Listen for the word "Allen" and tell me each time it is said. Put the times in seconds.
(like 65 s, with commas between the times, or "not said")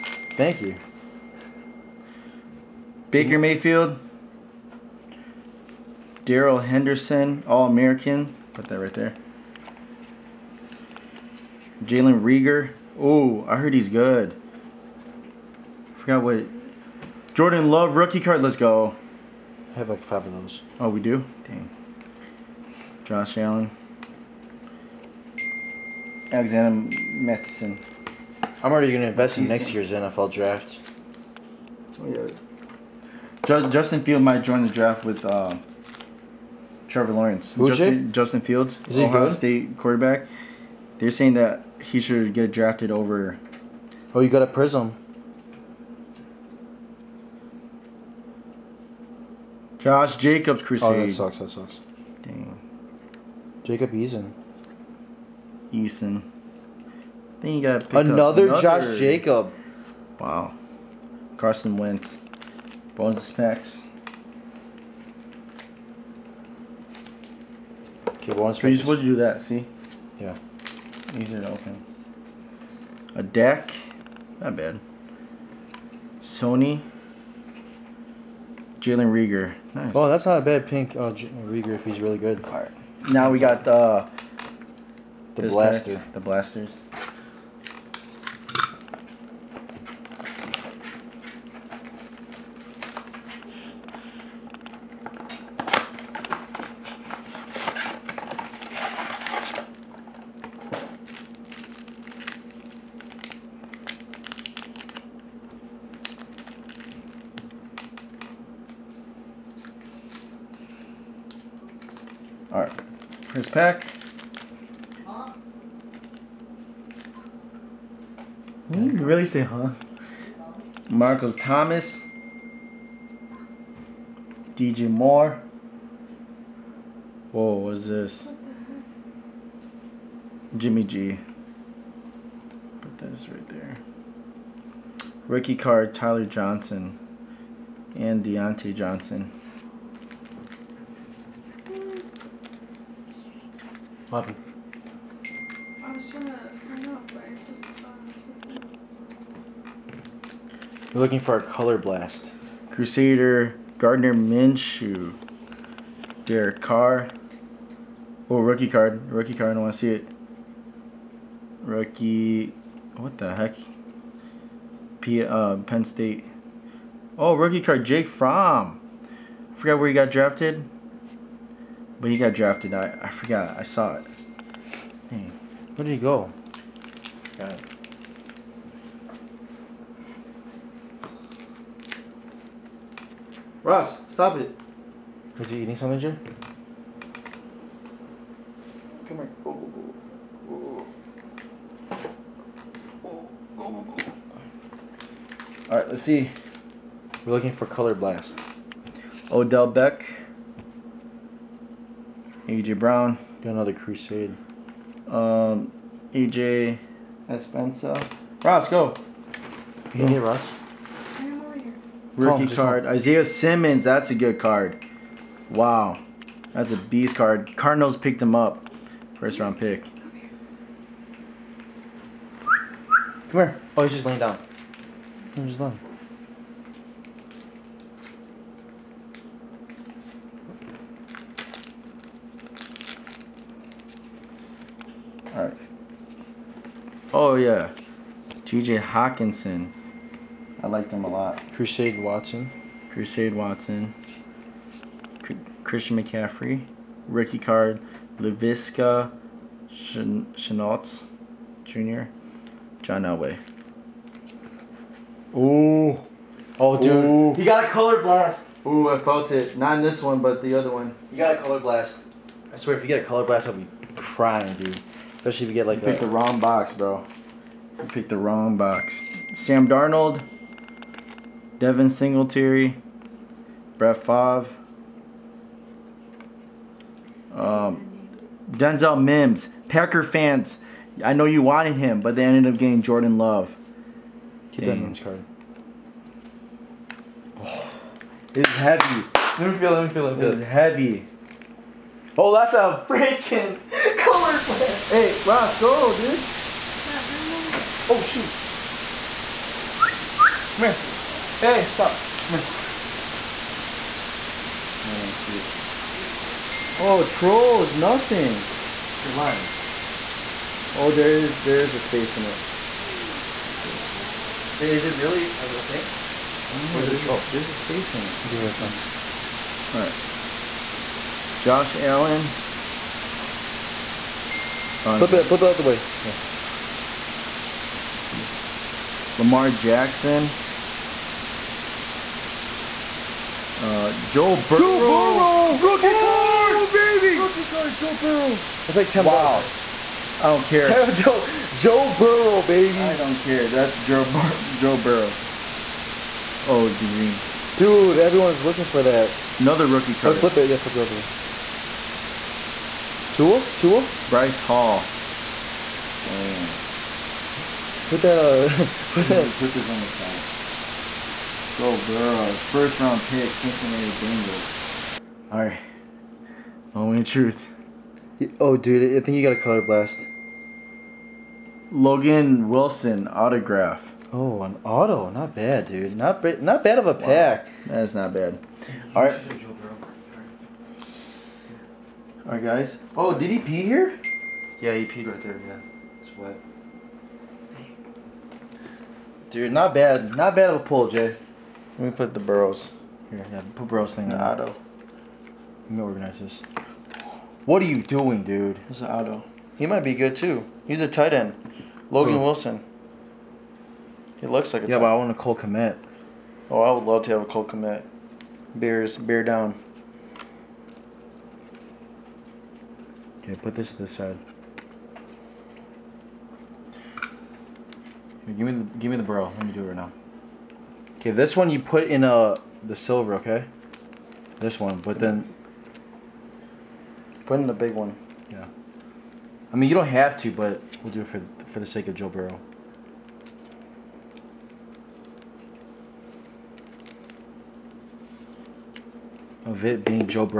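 23 s, 321 s.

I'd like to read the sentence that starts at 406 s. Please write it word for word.
Oh, I would love to have a Cole Kmet.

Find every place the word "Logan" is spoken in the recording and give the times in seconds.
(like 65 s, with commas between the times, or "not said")
371 s, 401 s.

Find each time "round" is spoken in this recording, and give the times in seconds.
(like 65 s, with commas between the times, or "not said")
219 s, 362 s.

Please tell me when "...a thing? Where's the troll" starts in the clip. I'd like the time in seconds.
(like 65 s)
315 s.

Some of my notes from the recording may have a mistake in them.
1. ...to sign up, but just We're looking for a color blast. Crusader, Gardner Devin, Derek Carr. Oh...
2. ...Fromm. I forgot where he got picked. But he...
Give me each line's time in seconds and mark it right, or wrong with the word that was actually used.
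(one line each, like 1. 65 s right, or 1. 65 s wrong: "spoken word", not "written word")
1. 146 s wrong: "Minshew", not "Devin"
2. 168 s wrong: "drafted", not "picked".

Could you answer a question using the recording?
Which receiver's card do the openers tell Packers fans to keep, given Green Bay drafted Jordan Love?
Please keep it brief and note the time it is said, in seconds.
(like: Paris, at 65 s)
Denzel Mims, at 278 s.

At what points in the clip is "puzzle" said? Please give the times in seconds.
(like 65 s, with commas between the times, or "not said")
not said.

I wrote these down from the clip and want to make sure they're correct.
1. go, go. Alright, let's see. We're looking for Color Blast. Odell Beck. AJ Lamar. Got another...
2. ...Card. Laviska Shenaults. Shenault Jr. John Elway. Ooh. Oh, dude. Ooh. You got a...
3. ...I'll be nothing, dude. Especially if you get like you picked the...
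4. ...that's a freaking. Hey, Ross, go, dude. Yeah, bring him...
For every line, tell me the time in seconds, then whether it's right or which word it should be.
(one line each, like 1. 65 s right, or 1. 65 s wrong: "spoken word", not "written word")
1. 193 s wrong: "Brown", not "Lamar"
2. 247 s right
3. 263 s wrong: "crying", not "nothing"
4. 292 s right.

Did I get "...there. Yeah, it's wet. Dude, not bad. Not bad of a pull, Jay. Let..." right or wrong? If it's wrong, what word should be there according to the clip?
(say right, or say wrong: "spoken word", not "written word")
right.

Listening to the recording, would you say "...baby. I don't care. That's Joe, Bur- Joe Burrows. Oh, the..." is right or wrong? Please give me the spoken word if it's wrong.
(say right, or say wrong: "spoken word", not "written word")
right.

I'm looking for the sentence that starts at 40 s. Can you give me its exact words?
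They're saying that he should get drafted over.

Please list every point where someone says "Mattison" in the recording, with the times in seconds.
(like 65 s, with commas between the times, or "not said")
27 s.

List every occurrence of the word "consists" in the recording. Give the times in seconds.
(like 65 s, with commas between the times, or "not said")
not said.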